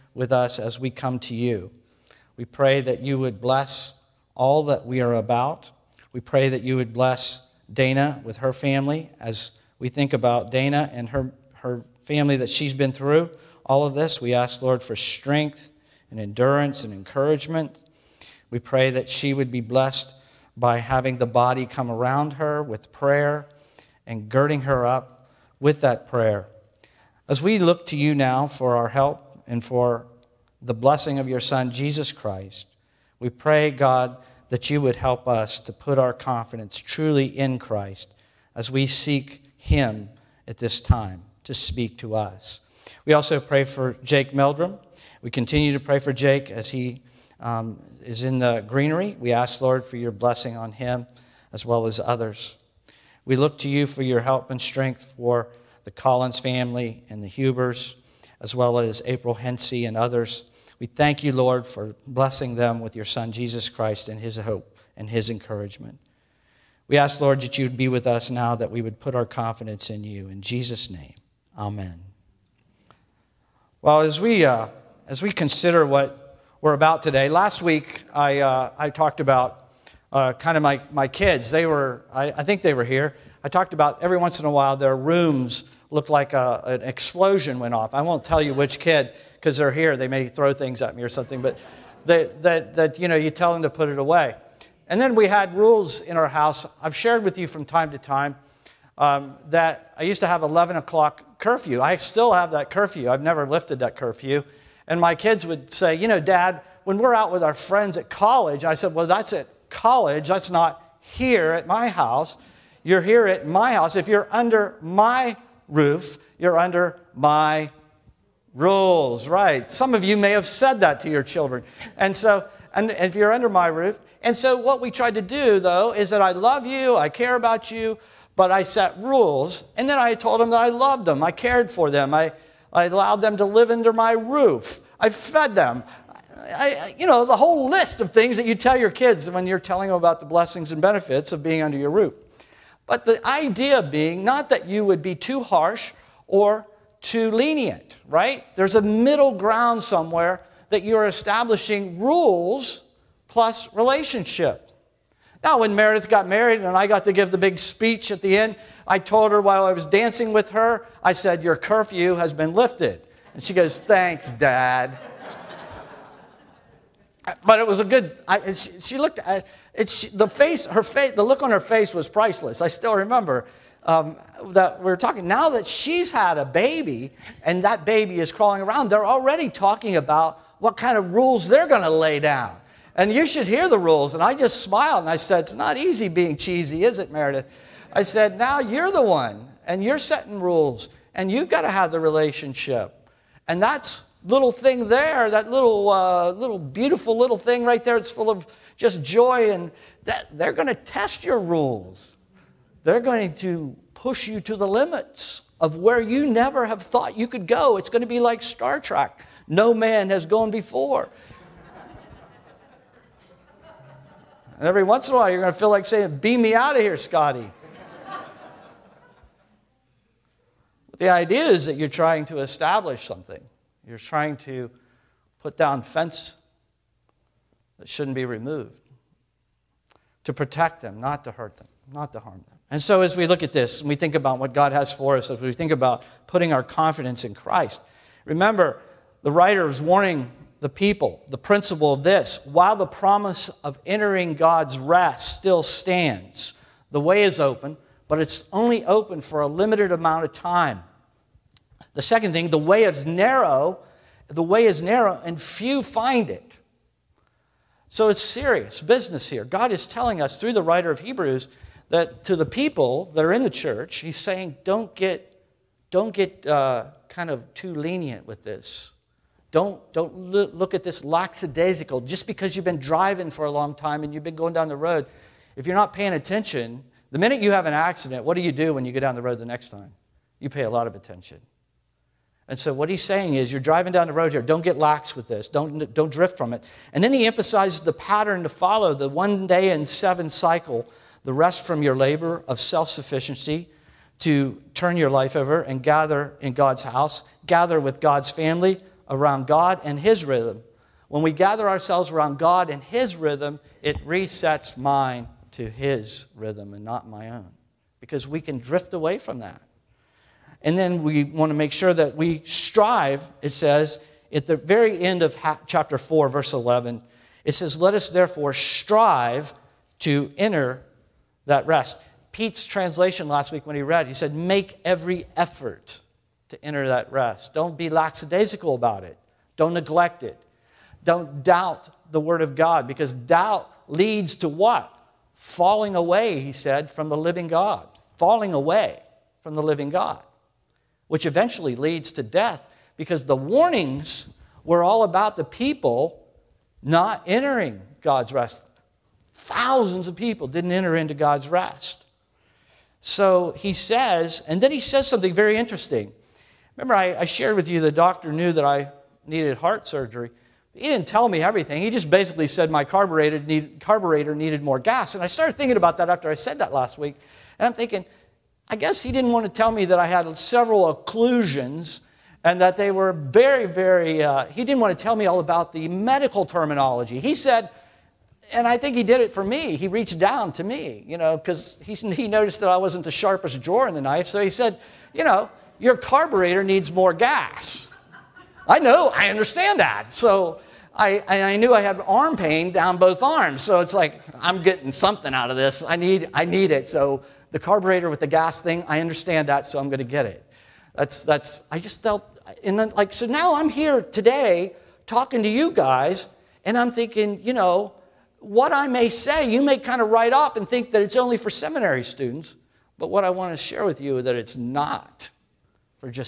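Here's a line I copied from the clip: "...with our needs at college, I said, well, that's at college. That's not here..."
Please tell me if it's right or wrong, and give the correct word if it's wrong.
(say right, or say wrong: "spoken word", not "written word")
wrong: "friends", not "needs".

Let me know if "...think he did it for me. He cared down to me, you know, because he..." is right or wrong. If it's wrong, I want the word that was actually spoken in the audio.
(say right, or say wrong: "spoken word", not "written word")
wrong: "reached", not "cared".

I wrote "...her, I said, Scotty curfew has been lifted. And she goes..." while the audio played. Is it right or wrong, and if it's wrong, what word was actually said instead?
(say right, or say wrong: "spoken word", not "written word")
wrong: "Your", not "Scotty".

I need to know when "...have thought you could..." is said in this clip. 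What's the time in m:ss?
3:26.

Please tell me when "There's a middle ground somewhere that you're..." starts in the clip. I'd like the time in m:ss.
2:28.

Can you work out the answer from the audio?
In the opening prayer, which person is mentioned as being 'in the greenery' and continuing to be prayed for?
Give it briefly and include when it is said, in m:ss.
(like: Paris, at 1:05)
Jake Meldrum, at 0:44.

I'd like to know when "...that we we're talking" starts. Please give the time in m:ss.
2:54.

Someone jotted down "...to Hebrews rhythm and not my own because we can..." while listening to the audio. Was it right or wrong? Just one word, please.
wrong.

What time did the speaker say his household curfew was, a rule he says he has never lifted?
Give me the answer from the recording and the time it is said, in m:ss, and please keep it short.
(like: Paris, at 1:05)
11 o'clock, at 1:40.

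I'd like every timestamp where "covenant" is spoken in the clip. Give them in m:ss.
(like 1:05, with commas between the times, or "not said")
not said.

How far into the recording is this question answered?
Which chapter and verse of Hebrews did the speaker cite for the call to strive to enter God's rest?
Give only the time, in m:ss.
5:15.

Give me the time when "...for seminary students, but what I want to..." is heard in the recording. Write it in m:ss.
6:51.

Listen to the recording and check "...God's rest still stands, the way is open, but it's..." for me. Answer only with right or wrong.
right.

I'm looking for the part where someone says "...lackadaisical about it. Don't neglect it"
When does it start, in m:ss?
5:27.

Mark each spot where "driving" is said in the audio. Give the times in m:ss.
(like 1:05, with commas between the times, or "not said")
4:32, 4:43.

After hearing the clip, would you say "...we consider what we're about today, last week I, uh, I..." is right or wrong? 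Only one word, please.
right.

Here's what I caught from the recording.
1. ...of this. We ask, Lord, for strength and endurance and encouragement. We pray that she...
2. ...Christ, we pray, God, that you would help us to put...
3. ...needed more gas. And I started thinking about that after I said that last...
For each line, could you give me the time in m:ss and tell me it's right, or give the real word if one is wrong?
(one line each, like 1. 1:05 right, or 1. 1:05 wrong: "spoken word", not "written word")
1. 0:13 right
2. 0:32 right
3. 6:04 right.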